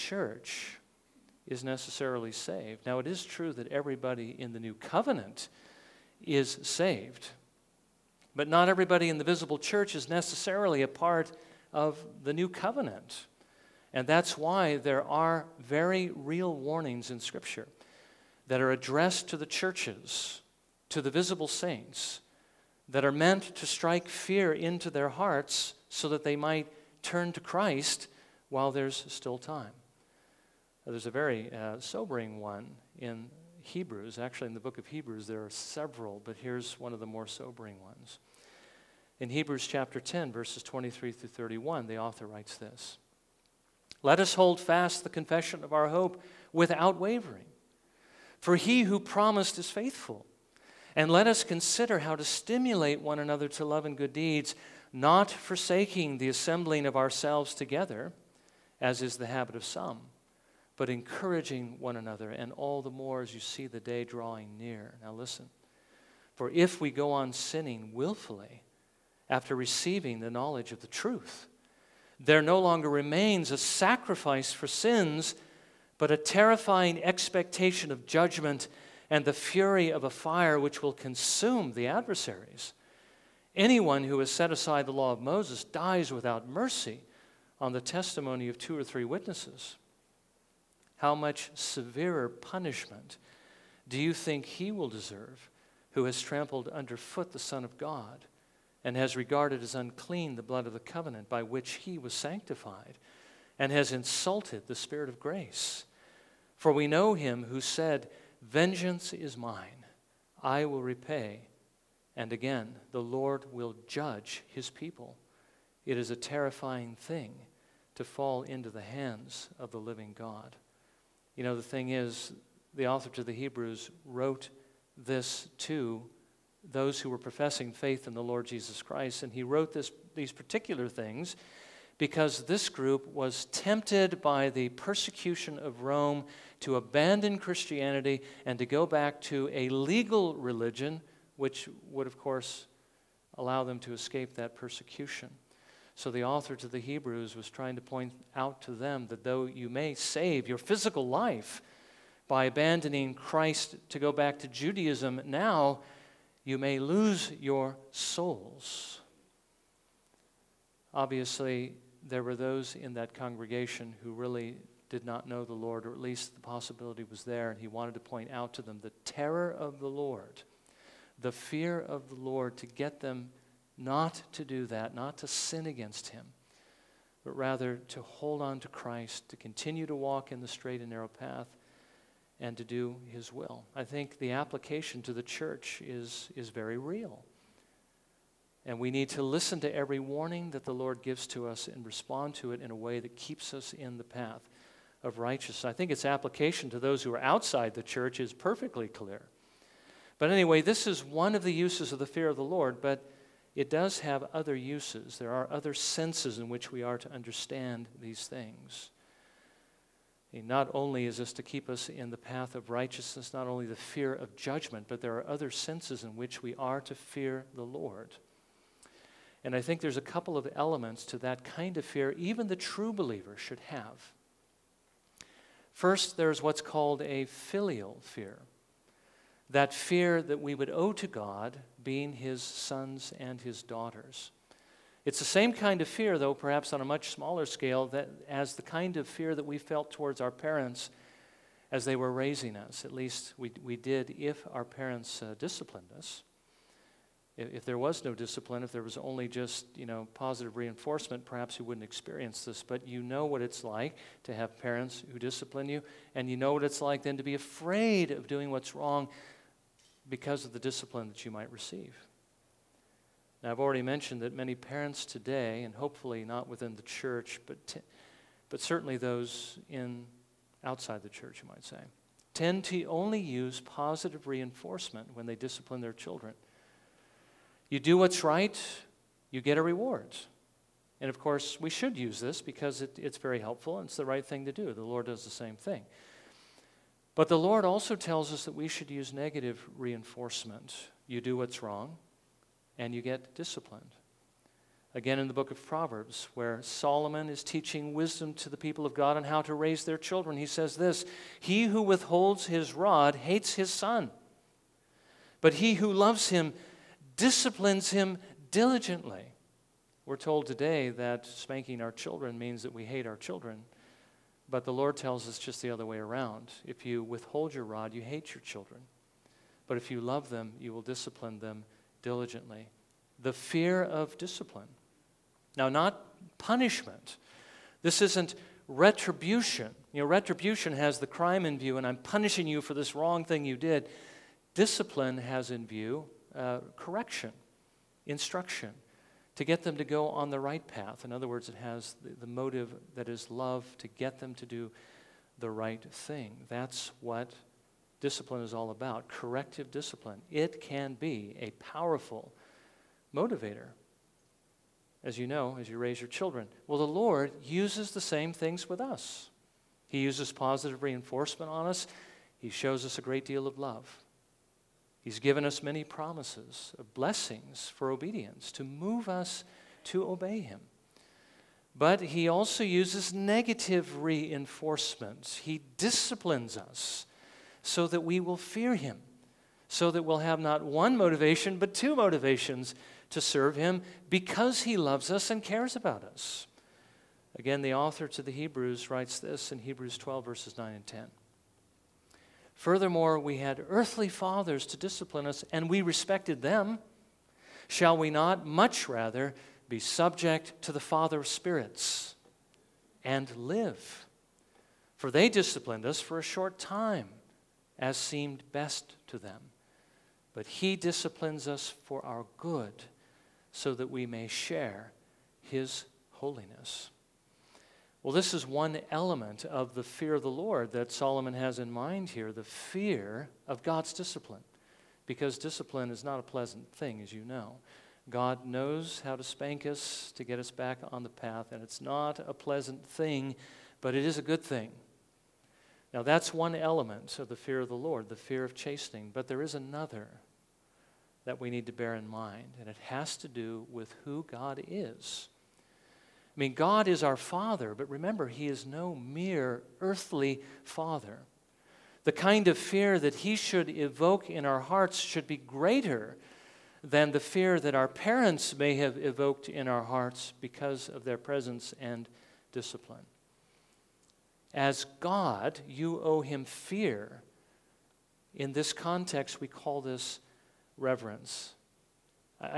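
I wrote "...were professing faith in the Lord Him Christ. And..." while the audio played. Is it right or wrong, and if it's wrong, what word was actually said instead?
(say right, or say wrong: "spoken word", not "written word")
wrong: "Jesus", not "Him".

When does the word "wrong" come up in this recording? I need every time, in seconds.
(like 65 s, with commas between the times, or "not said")
258 s, 291 s, 332 s.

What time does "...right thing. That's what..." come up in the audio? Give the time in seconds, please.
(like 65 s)
345 s.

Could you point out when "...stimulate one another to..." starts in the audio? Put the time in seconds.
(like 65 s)
52 s.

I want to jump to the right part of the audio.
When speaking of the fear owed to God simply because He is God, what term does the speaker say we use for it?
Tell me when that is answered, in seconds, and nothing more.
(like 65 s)
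470 s.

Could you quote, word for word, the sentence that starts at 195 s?
I think its application to those who are outside the church is perfectly clear.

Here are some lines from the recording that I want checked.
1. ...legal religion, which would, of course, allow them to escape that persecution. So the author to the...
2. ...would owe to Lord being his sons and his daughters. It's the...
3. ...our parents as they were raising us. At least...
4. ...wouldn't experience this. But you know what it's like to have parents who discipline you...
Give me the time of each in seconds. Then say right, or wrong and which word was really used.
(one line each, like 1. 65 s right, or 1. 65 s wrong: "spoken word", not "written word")
1. 139 s right
2. 230 s wrong: "God", not "Lord"
3. 240 s right
4. 251 s right.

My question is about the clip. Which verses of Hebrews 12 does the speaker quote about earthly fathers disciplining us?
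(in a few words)
Verses 9 and 10.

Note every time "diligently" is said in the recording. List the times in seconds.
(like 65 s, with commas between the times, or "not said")
308 s, 322 s.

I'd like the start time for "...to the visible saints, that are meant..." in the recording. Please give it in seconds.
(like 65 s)
20 s.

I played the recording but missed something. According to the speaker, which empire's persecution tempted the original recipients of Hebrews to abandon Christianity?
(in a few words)
Rome.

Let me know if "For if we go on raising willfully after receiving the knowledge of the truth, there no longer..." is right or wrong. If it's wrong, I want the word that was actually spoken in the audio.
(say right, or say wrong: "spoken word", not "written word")
wrong: "sinning", not "raising".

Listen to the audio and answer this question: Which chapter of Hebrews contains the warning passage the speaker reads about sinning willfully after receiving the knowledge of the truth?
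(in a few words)
Chapter 10.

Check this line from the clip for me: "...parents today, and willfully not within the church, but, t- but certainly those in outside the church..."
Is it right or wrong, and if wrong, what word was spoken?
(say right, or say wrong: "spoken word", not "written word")
wrong: "hopefully", not "willfully".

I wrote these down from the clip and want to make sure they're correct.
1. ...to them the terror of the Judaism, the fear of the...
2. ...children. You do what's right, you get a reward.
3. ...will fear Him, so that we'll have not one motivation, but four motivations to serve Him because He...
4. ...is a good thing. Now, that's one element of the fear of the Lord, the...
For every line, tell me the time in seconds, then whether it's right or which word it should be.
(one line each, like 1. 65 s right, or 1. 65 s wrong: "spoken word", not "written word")
1. 168 s wrong: "Lord", not "Judaism"
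2. 275 s right
3. 378 s wrong: "two", not "four"
4. 434 s right.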